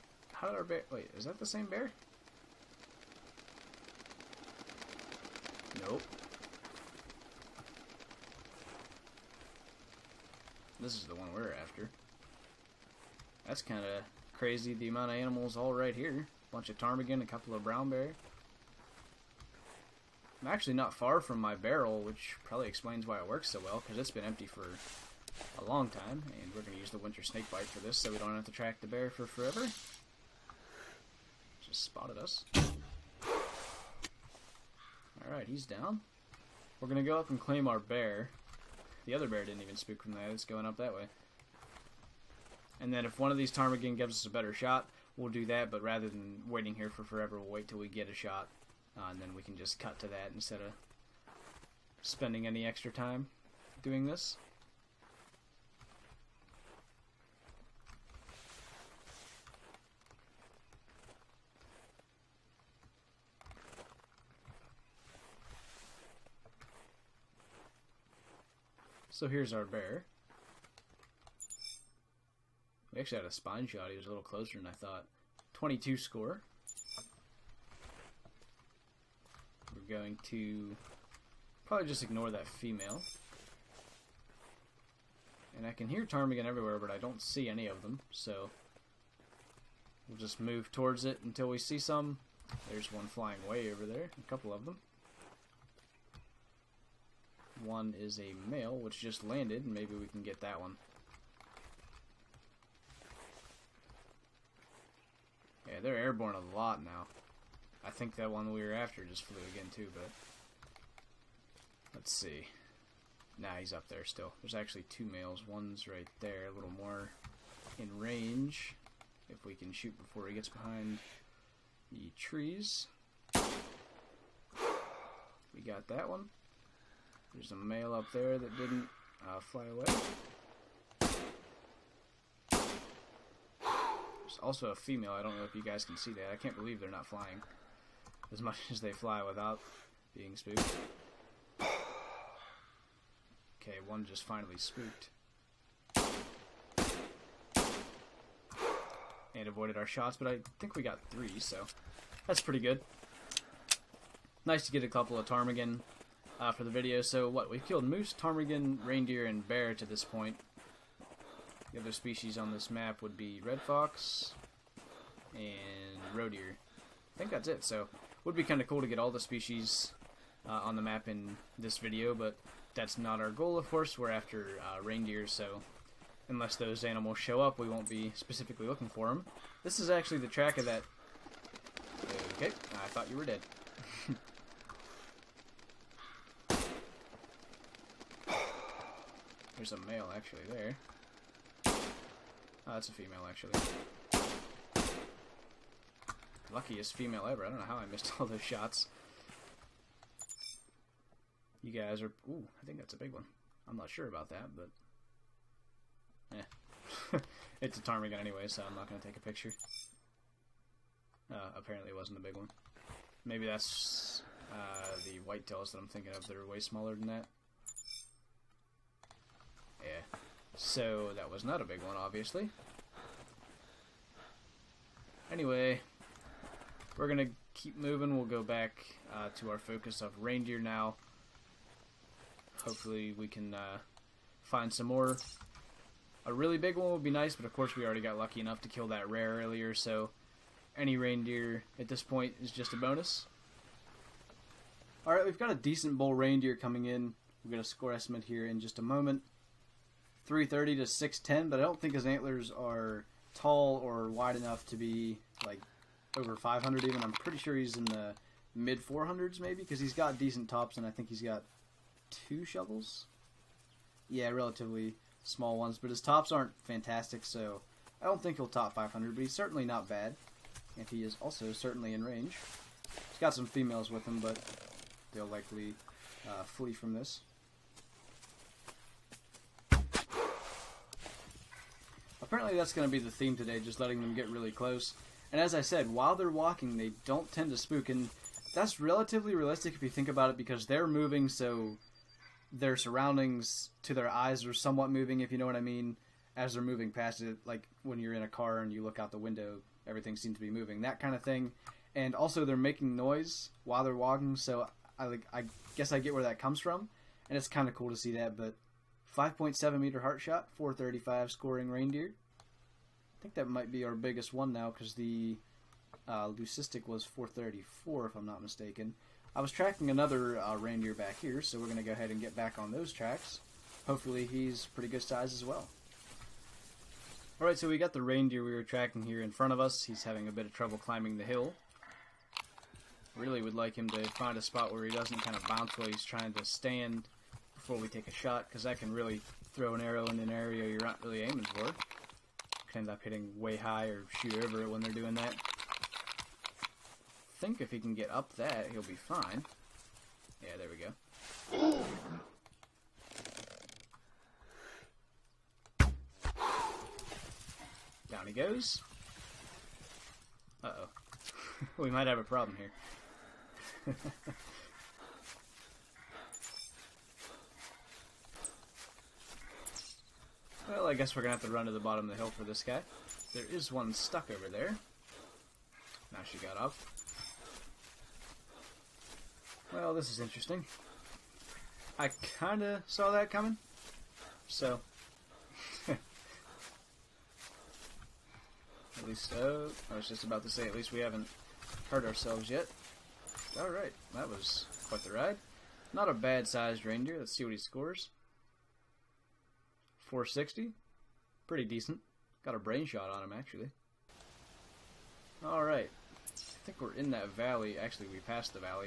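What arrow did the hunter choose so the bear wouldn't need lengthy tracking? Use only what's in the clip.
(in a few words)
winter snake bite.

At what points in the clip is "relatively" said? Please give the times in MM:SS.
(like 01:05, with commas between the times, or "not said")
04:24, 04:48.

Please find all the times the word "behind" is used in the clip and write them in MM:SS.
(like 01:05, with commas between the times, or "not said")
02:00.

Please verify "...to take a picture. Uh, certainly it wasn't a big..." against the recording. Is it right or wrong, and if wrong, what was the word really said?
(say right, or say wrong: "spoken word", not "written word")
wrong: "apparently", not "certainly".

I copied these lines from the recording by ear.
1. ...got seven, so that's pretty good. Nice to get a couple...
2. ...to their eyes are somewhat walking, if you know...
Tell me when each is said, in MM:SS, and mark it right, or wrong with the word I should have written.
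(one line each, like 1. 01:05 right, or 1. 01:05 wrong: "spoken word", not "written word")
1. 02:30 wrong: "three", not "seven"
2. 04:53 wrong: "moving", not "walking".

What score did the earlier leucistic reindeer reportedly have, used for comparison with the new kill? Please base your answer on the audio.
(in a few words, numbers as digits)
434.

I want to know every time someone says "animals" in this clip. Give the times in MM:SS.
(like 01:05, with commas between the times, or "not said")
00:15, 02:56.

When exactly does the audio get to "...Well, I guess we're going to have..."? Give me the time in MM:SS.
06:10.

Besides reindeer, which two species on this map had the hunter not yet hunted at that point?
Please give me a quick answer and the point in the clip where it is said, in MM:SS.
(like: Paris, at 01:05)
red fox and roe deer, at 02:43.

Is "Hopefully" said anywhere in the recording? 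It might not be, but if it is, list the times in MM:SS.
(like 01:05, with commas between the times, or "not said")
03:52, 05:23.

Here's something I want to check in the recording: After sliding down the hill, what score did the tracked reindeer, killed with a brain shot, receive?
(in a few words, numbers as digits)
460.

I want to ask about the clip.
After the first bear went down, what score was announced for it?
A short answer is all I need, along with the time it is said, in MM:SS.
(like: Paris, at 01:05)
22, at 01:15.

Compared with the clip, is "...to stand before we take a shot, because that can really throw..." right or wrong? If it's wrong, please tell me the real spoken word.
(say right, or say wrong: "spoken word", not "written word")
right.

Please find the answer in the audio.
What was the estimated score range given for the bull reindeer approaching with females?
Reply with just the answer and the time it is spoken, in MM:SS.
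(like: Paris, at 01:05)
330 to 610, at 04:10.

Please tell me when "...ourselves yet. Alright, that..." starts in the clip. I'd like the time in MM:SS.
06:32.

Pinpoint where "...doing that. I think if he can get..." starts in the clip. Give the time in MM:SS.
05:44.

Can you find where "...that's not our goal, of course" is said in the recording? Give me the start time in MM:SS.
02:52.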